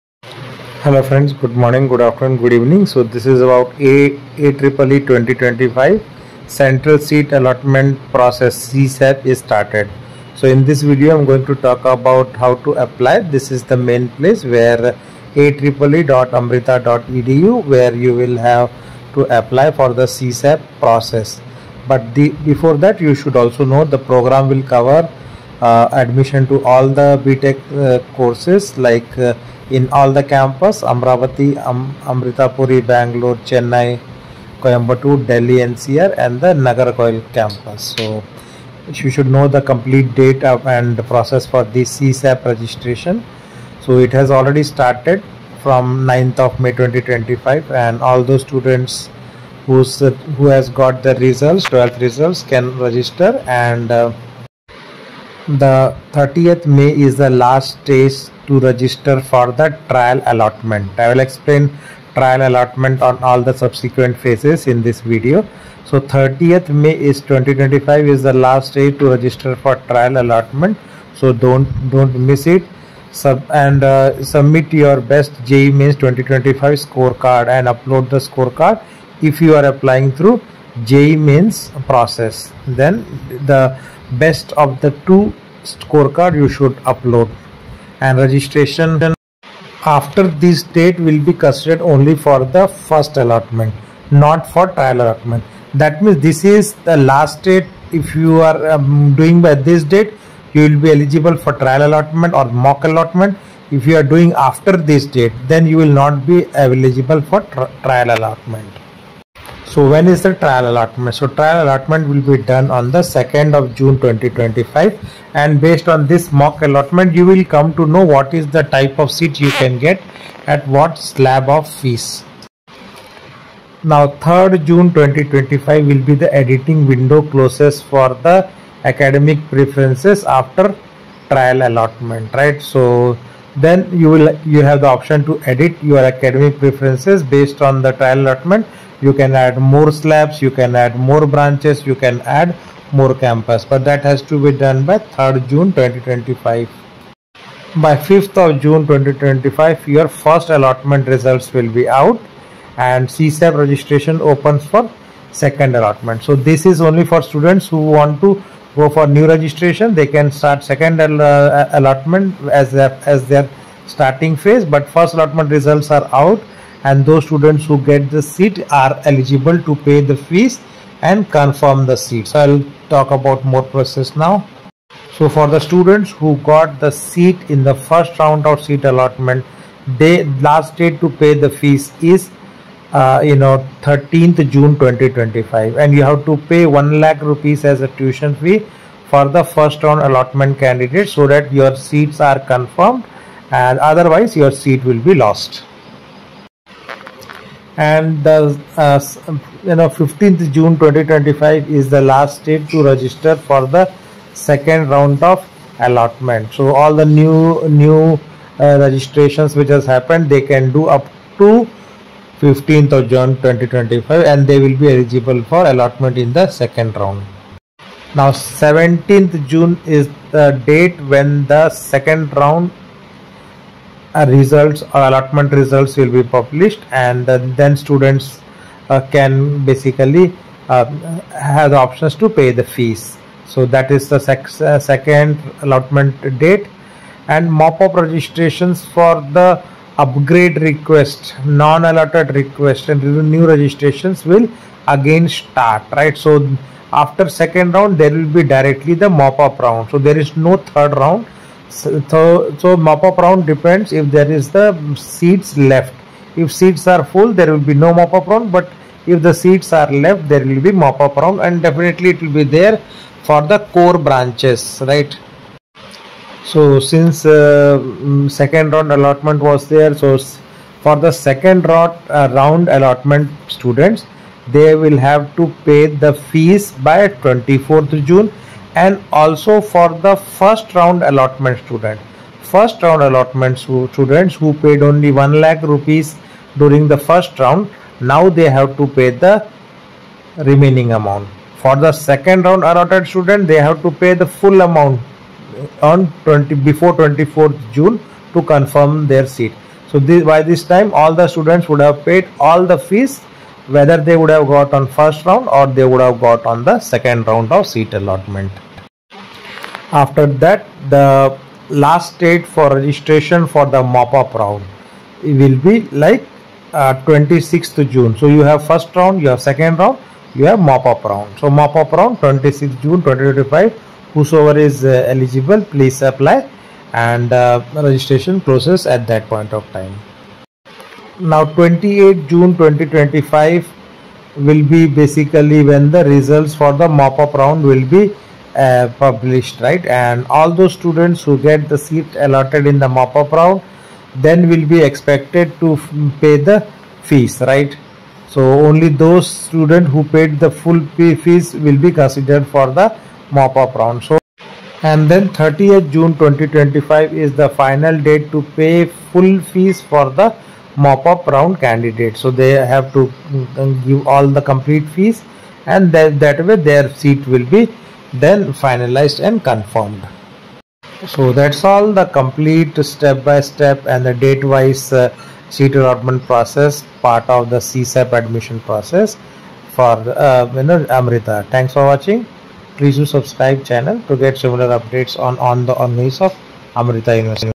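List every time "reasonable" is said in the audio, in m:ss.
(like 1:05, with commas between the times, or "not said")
not said.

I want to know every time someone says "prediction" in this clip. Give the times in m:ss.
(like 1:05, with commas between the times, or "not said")
not said.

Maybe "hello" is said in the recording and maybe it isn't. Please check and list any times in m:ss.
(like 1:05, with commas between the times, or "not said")
0:00.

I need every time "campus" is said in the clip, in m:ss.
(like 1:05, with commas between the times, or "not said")
0:30, 0:37, 2:23.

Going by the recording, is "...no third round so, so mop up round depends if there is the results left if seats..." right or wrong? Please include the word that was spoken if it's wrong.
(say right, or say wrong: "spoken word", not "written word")
wrong: "seats", not "results".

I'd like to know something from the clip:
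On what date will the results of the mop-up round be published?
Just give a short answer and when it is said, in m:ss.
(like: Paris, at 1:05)
28 June 2025, at 5:31.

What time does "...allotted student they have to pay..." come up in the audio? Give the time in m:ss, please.
4:52.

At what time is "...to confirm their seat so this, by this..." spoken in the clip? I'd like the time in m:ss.
4:58.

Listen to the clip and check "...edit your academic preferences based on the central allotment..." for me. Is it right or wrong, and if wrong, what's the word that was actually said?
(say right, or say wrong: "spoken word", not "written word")
wrong: "trial", not "central".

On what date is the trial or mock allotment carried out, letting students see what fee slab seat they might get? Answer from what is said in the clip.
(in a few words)
2 June 2025.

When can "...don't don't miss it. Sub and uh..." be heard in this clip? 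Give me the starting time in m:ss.
1:11.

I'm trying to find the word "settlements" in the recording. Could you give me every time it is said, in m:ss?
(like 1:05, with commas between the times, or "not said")
not said.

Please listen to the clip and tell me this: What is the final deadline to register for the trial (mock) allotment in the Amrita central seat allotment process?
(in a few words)
30 May 2025.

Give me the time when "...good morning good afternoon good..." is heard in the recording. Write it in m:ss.
0:01.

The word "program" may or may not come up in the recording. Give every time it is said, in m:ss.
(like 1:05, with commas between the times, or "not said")
0:24.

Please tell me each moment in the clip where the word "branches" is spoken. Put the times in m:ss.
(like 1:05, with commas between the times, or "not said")
2:21, 4:23.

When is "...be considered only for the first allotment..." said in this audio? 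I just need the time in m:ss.
1:31.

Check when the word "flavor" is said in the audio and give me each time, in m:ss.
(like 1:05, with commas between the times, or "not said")
not said.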